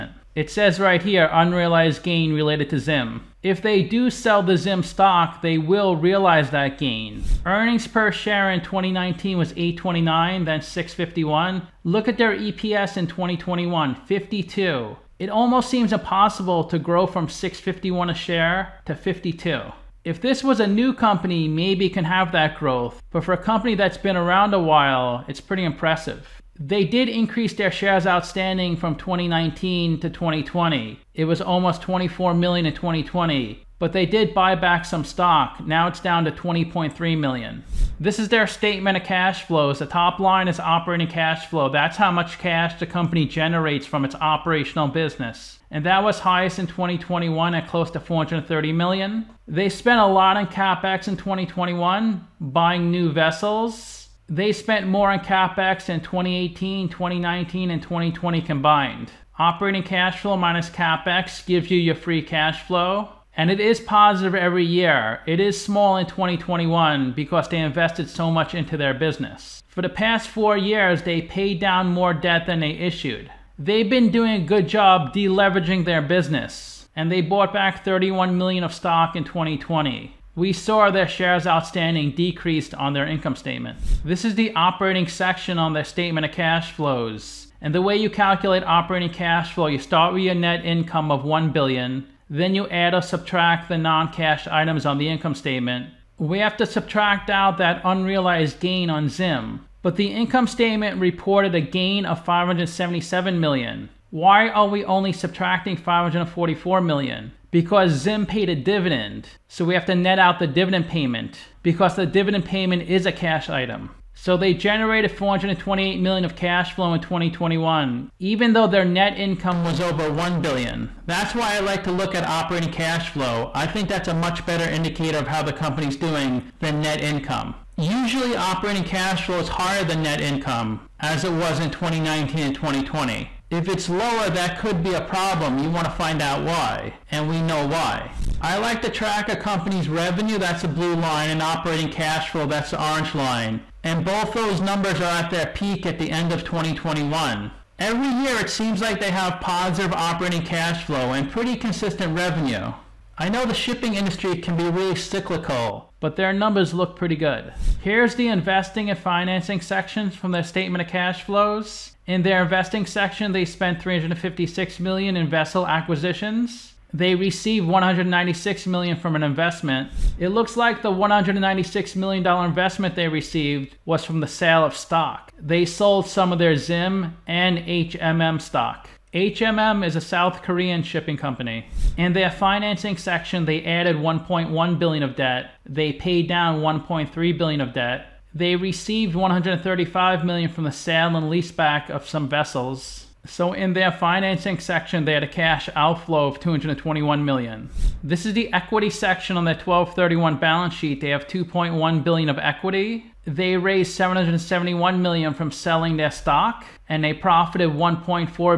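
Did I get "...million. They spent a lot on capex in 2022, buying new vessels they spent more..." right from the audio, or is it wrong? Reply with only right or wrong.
wrong.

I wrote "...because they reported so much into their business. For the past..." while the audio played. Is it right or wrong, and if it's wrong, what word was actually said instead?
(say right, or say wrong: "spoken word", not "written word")
wrong: "invested", not "reported".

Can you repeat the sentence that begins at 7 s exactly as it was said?
Earnings per share in 2019 was 8.29, then 6.51.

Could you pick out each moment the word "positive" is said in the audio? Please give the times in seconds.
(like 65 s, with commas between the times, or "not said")
63 s, 149 s.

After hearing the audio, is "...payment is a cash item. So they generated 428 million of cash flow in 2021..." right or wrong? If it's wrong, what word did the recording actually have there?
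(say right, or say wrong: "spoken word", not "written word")
right.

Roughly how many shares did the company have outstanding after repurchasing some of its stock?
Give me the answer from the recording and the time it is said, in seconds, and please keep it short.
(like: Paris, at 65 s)
20.3 million, at 36 s.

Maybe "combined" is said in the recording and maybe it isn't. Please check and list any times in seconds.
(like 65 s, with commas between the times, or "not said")
58 s.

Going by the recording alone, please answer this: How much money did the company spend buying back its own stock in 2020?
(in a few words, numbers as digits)
31 million.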